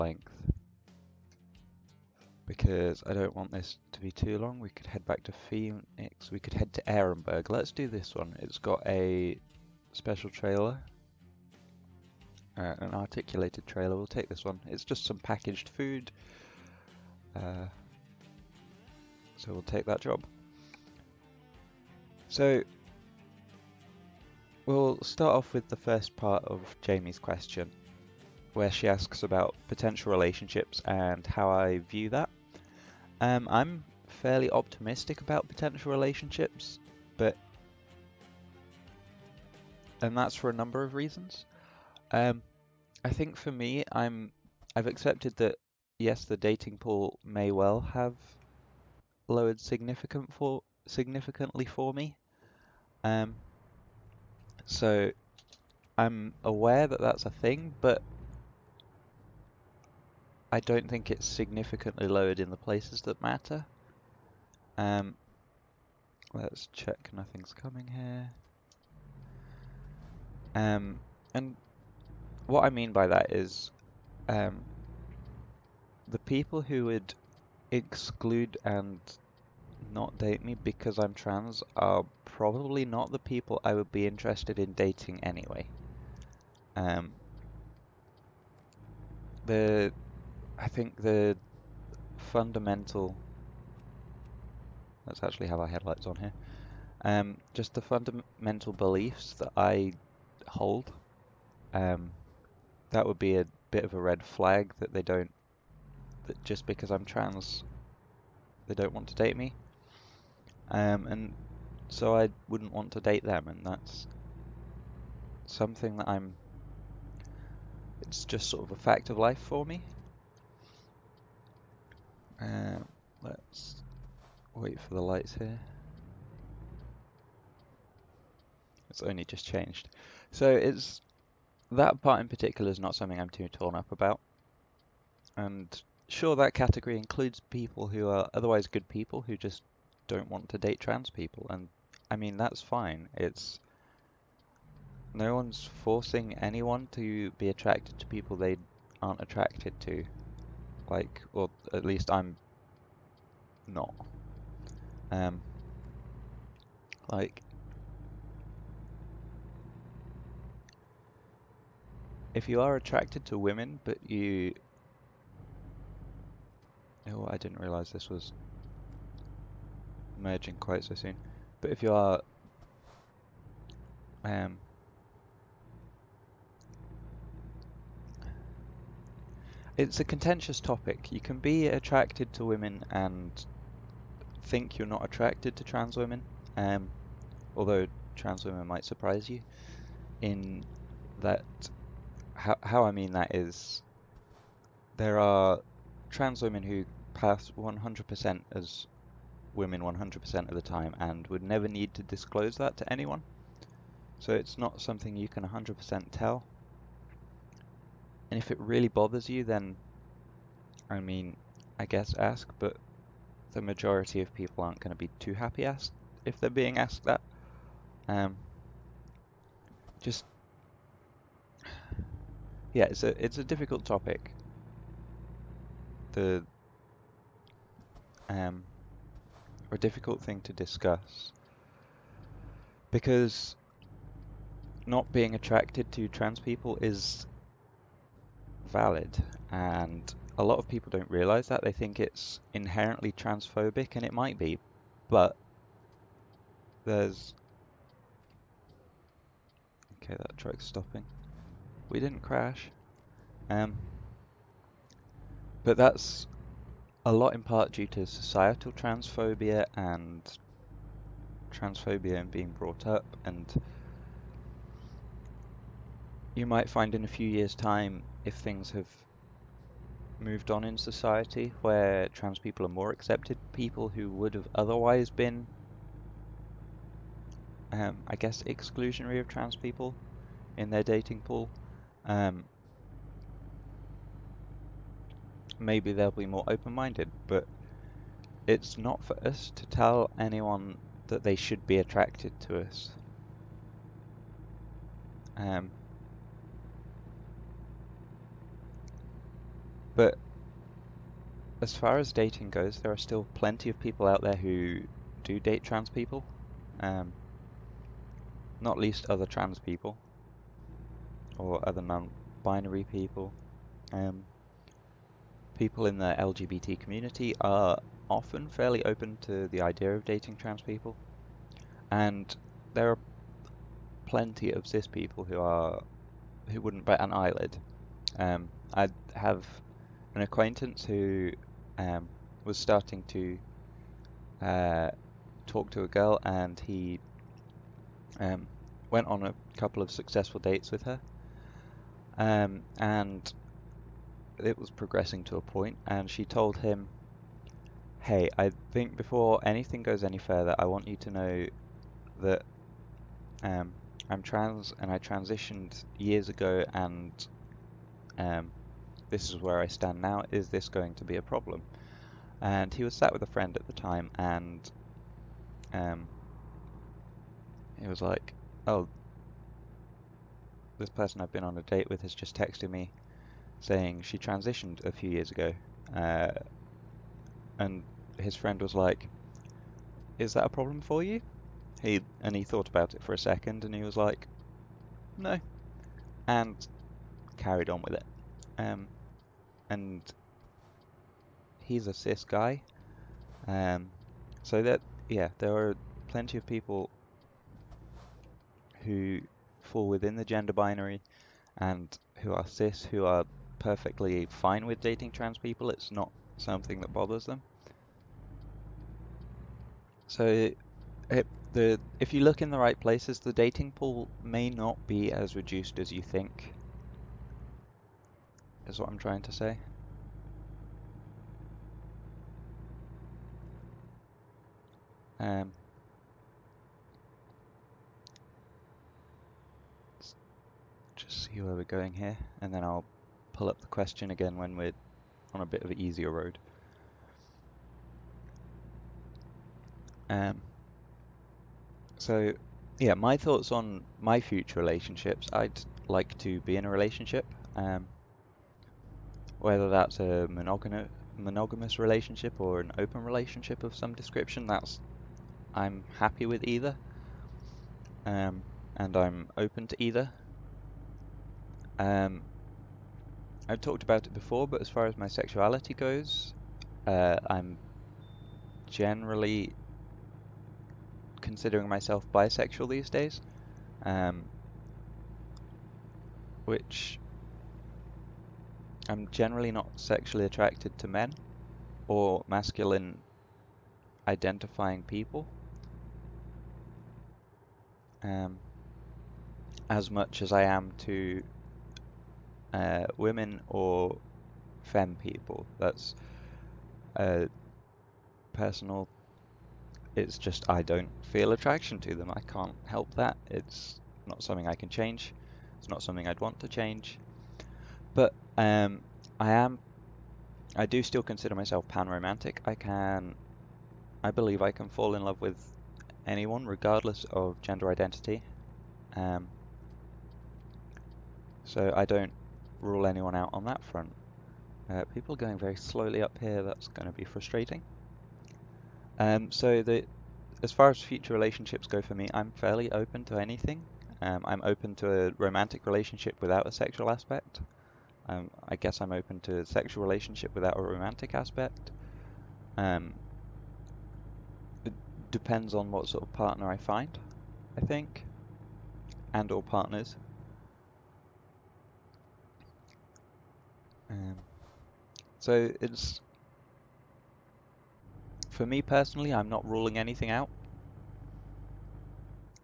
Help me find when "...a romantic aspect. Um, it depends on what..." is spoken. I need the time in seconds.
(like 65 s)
540 s.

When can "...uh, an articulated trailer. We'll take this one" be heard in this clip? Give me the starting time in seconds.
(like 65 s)
12 s.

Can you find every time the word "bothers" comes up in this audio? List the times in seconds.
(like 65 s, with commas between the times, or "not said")
208 s, 406 s.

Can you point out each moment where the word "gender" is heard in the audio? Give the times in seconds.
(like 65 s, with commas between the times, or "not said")
400 s, 517 s.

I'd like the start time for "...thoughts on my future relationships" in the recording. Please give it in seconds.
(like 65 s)
443 s.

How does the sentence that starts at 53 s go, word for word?
Um, so I'm aware that that's a thing, but I don't think it's significantly lowered in the places that matter.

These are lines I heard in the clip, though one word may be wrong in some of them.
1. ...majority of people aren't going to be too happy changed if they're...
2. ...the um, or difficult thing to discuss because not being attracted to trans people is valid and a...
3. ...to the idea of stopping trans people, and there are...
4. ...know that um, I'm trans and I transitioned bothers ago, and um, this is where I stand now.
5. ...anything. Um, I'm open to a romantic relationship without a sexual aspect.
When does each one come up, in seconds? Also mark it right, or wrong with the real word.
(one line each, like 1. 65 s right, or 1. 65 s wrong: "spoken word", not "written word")
1. 213 s wrong: "asked", not "changed"
2. 226 s right
3. 319 s wrong: "dating", not "stopping"
4. 351 s wrong: "years", not "bothers"
5. 533 s right.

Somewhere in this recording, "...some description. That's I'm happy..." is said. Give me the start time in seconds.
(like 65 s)
453 s.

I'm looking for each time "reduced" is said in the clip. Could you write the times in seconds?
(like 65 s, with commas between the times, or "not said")
415 s.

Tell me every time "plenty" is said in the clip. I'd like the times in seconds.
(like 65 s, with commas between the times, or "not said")
303 s, 324 s, 396 s.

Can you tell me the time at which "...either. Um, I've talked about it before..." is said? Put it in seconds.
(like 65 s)
459 s.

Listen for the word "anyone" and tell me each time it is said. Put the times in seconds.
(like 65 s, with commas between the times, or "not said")
146 s, 202 s, 290 s, 516 s, 522 s.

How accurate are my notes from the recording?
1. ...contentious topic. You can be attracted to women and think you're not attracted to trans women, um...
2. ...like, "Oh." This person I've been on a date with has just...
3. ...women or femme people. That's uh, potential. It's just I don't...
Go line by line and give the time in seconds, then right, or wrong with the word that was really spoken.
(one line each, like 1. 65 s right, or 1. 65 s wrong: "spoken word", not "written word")
1. 180 s right
2. 368 s right
3. 492 s wrong: "personal", not "potential".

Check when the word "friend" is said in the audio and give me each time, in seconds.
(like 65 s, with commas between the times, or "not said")
363 s, 378 s.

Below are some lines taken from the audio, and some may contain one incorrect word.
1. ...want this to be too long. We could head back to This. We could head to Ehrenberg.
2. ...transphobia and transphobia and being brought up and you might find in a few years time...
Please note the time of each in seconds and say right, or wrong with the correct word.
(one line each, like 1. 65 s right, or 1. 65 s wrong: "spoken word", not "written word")
1. 3 s wrong: "Phoenix", not "This"
2. 258 s right.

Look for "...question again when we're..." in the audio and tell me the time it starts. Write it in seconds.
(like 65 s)
433 s.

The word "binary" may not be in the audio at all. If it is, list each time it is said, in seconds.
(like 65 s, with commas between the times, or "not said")
311 s, 400 s.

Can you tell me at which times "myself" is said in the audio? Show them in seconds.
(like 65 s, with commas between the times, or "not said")
471 s, 511 s.